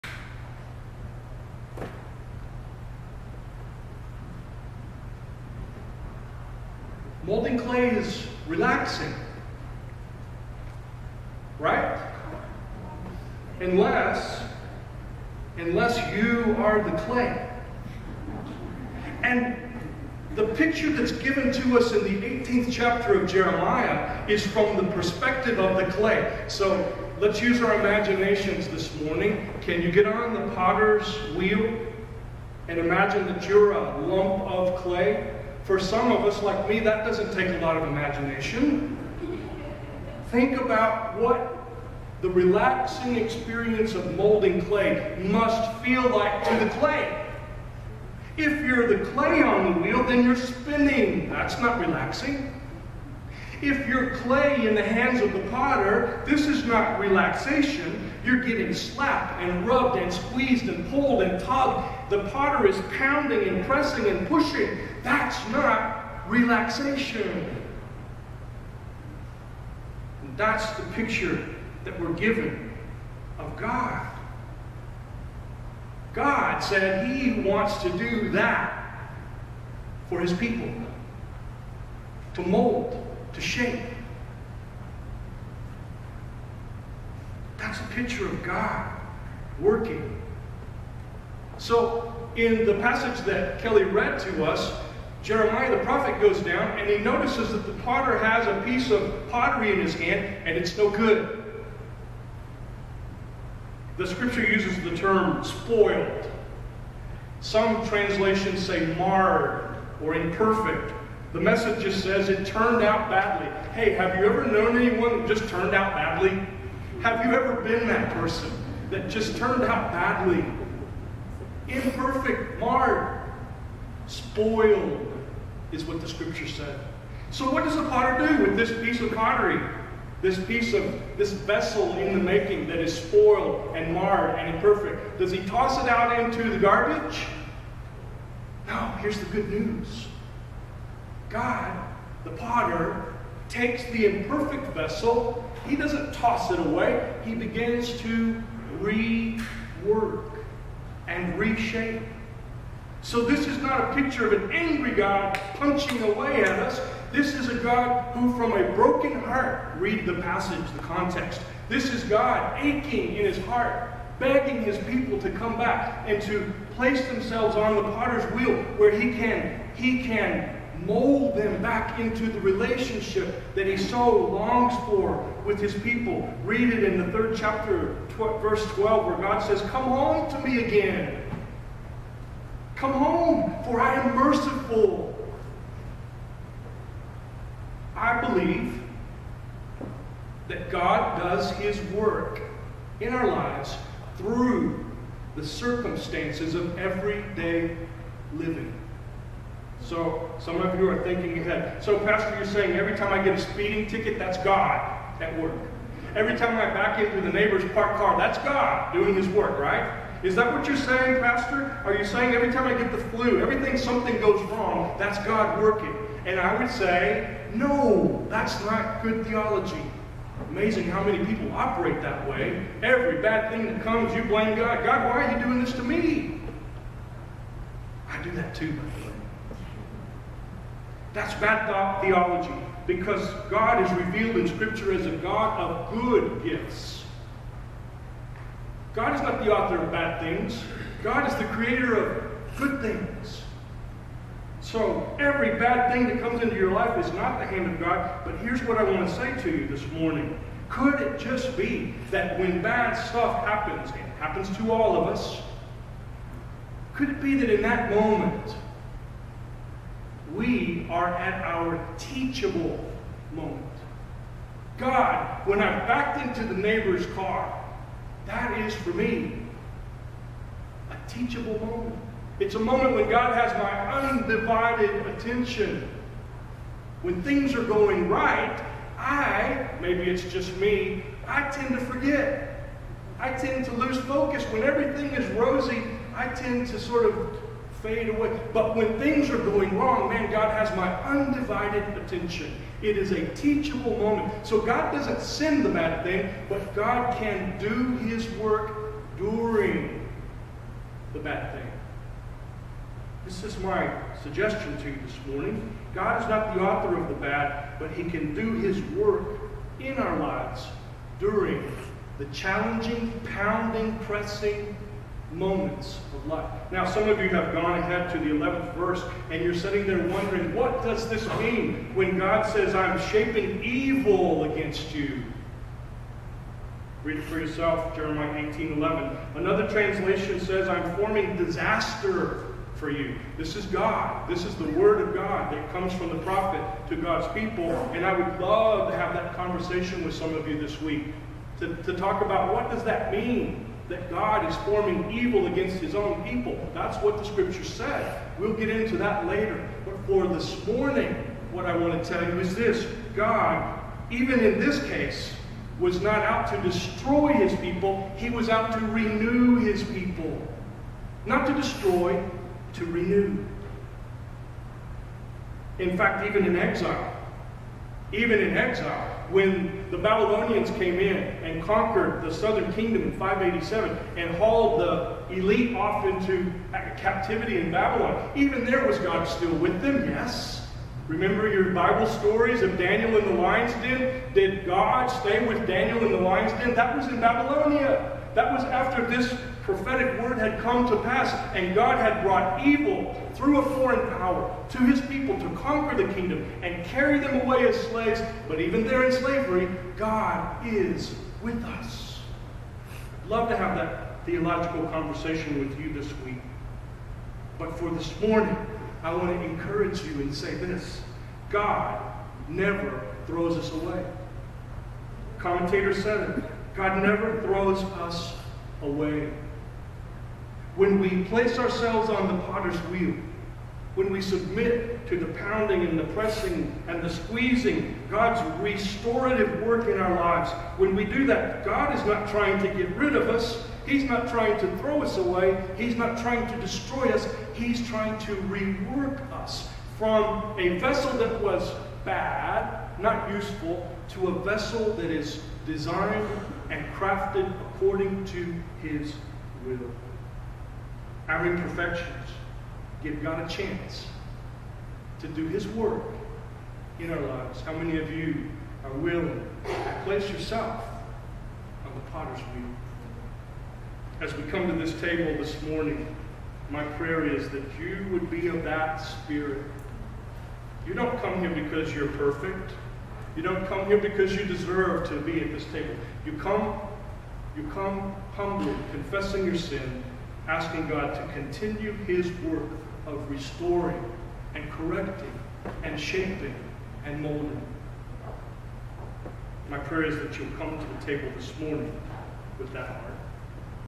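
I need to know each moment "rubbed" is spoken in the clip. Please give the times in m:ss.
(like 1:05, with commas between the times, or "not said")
0:59.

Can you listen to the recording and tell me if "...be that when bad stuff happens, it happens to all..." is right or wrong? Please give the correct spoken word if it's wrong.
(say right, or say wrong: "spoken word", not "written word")
right.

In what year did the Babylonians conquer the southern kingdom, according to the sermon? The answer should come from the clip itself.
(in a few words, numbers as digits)
587.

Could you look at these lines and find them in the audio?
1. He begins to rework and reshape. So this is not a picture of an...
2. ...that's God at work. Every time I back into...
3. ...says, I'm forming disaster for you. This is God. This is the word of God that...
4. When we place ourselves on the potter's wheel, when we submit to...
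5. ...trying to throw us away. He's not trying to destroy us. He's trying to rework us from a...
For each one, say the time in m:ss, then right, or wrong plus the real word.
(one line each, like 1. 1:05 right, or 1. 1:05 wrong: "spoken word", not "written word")
1. 2:27 right
2. 3:24 right
3. 5:30 right
4. 7:00 right
5. 7:14 right.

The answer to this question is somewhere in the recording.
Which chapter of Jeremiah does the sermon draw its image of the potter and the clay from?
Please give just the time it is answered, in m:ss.
0:22.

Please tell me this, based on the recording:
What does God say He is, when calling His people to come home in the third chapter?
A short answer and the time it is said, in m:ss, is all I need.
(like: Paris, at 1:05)
merciful, at 3:04.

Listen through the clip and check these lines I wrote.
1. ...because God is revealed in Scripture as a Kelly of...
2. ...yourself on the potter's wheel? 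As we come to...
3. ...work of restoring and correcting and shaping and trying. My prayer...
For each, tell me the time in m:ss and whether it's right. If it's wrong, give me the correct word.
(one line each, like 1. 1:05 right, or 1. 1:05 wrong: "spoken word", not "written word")
1. 3:52 wrong: "God", not "Kelly"
2. 7:40 right
3. 8:02 wrong: "molding", not "trying".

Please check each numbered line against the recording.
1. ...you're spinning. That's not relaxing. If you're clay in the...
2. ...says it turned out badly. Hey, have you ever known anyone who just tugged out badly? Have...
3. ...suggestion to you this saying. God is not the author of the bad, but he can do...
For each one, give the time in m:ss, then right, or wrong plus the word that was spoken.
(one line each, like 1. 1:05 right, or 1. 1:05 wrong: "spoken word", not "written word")
1. 0:50 right
2. 1:52 wrong: "turned", not "tugged"
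3. 5:04 wrong: "morning", not "saying".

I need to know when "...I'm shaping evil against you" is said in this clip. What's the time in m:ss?
5:22.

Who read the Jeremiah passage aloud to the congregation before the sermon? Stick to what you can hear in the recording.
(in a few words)
Kelly.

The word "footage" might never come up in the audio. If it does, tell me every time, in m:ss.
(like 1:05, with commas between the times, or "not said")
not said.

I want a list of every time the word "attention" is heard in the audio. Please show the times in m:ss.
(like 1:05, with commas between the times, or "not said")
4:35, 4:51.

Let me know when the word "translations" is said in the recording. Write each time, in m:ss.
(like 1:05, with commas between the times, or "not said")
1:47, 5:29.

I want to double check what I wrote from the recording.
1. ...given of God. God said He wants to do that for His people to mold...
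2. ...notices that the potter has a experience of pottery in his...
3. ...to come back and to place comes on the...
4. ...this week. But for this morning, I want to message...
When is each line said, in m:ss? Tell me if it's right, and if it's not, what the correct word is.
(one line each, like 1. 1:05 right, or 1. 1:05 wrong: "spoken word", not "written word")
1. 1:12 right
2. 1:36 wrong: "piece", not "experience"
3. 2:45 wrong: "themselves", not "comes"
4. 6:45 wrong: "encourage", not "message".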